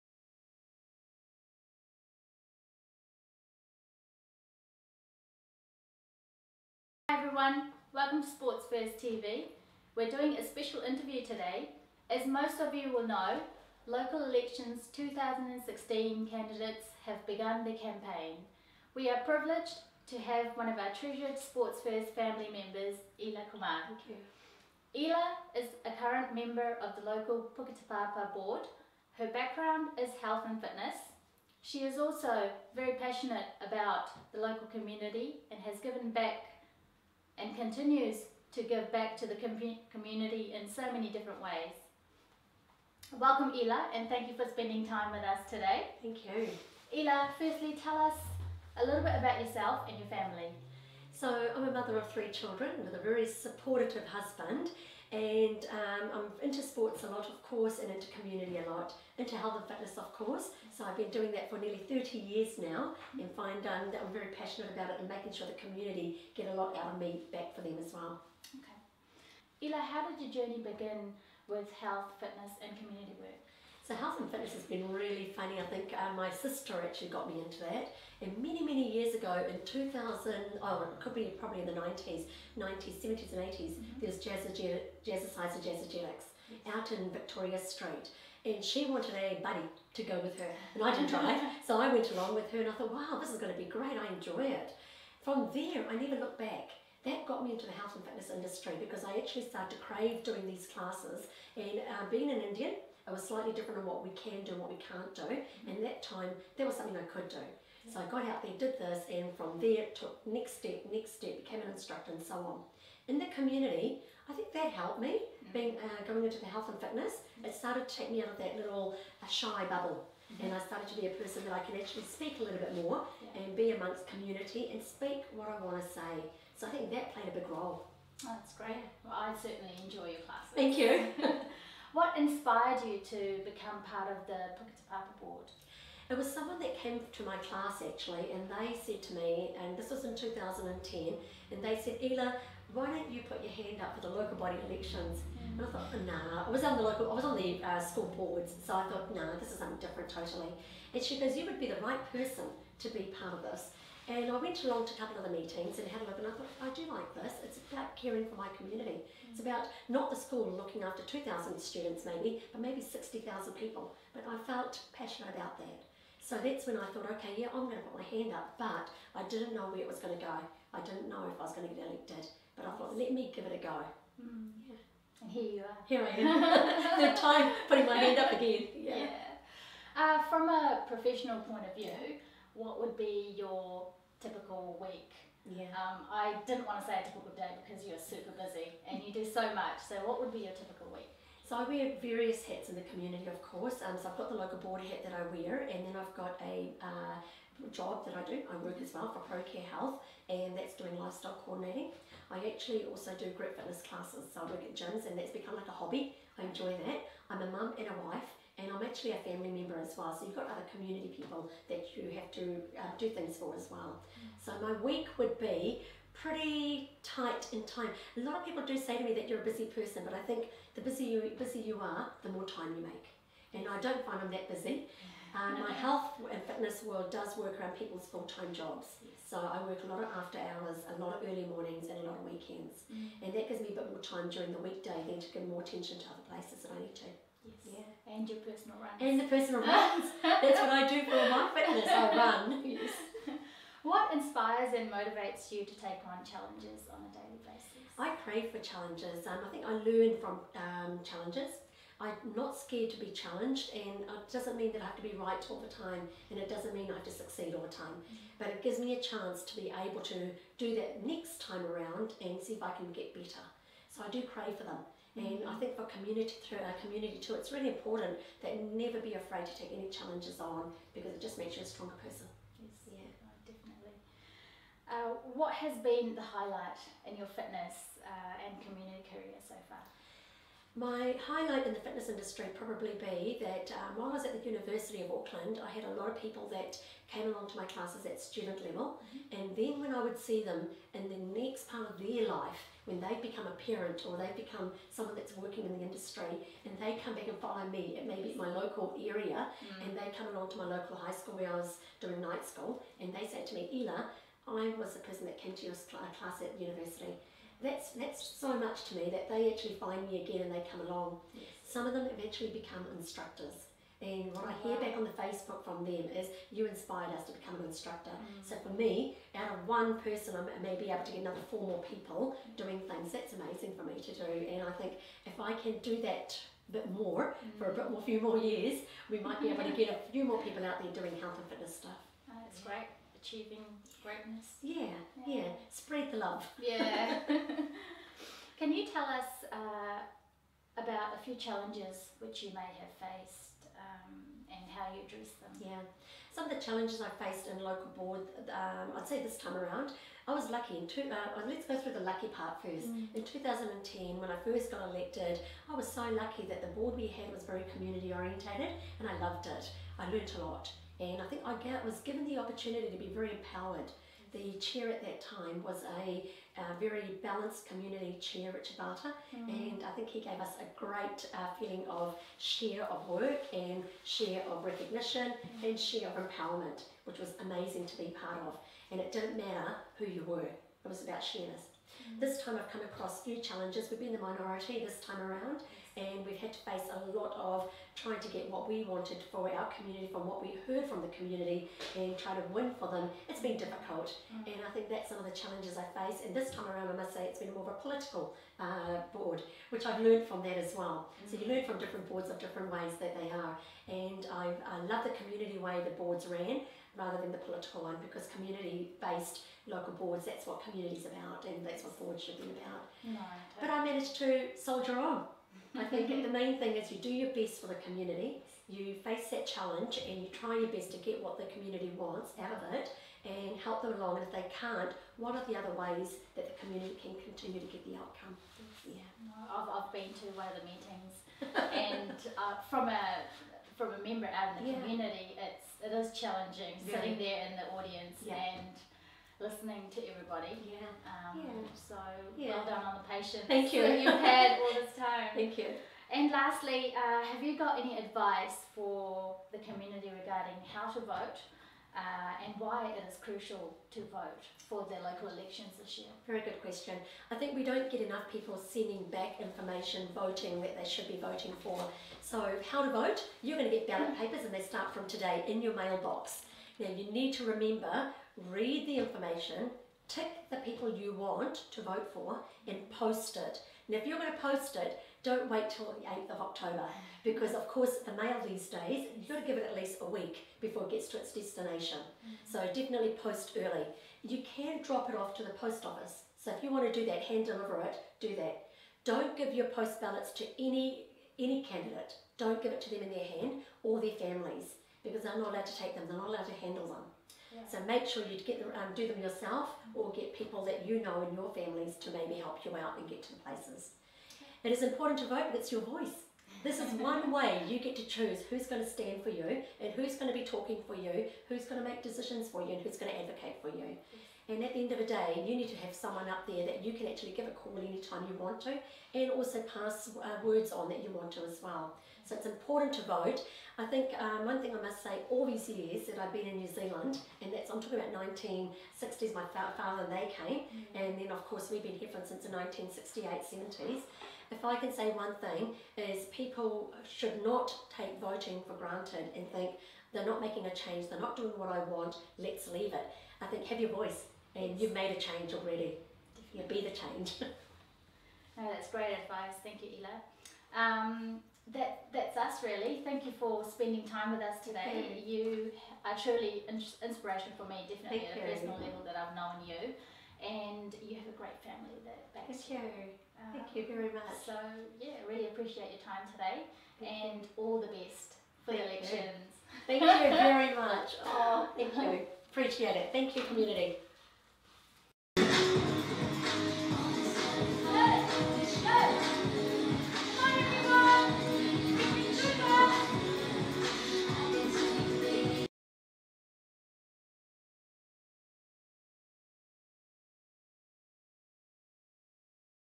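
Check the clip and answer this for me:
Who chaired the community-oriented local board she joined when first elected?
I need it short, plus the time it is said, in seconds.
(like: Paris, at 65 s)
Richard Barter, at 368 s.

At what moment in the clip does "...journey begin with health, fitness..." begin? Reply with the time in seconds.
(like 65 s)
70 s.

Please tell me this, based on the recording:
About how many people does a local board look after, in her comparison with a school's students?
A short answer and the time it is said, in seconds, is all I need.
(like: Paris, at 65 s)
60,000, at 162 s.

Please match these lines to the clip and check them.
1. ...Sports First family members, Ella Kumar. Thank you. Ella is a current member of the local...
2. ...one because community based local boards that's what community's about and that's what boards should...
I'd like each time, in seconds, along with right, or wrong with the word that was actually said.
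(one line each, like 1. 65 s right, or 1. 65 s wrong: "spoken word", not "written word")
1. 21 s right
2. 407 s right.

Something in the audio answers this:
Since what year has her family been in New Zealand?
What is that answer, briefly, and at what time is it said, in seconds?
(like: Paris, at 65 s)
1968, at 532 s.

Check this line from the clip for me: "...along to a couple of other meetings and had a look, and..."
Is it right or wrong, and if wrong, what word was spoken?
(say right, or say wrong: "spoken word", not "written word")
right.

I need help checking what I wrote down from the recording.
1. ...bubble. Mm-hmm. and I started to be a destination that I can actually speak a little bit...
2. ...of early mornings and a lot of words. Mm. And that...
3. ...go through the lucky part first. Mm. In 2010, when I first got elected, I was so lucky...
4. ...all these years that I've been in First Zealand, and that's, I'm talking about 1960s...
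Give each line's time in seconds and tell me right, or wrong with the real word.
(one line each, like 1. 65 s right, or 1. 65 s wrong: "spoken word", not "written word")
1. 119 s wrong: "person", not "destination"
2. 231 s wrong: "weekends", not "words"
3. 351 s right
4. 525 s wrong: "New", not "First".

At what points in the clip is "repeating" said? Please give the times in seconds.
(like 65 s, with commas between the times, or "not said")
not said.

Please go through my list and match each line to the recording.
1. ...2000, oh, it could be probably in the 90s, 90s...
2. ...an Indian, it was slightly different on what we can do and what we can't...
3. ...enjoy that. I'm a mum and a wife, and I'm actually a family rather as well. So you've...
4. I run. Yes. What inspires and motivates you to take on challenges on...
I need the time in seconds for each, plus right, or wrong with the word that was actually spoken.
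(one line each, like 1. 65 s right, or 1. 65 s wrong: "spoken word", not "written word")
1. 79 s right
2. 102 s right
3. 206 s wrong: "member", not "rather"
4. 241 s right.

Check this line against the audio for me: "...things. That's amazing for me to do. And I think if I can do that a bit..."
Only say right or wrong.
right.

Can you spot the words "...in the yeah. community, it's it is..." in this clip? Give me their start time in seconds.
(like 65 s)
434 s.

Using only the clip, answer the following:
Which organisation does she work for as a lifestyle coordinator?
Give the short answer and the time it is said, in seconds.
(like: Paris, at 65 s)
ProCare Health, at 199 s.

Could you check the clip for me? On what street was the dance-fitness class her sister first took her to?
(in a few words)
Victoria Street.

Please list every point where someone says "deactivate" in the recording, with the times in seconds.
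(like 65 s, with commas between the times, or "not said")
not said.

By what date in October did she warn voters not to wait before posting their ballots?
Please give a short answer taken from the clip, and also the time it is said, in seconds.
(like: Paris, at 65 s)
8 October, at 476 s.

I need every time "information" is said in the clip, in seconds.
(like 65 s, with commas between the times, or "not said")
459 s, 468 s.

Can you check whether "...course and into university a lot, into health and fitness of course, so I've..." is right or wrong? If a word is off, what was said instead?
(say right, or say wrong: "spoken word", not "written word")
wrong: "community", not "university".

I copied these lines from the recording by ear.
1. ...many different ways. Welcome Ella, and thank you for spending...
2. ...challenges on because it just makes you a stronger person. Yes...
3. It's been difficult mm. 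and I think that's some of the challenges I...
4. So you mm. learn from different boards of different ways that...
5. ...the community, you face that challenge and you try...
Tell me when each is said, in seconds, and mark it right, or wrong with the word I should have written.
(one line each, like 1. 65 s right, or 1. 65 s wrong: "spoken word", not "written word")
1. 40 s right
2. 269 s right
3. 393 s right
4. 401 s right
5. 417 s right.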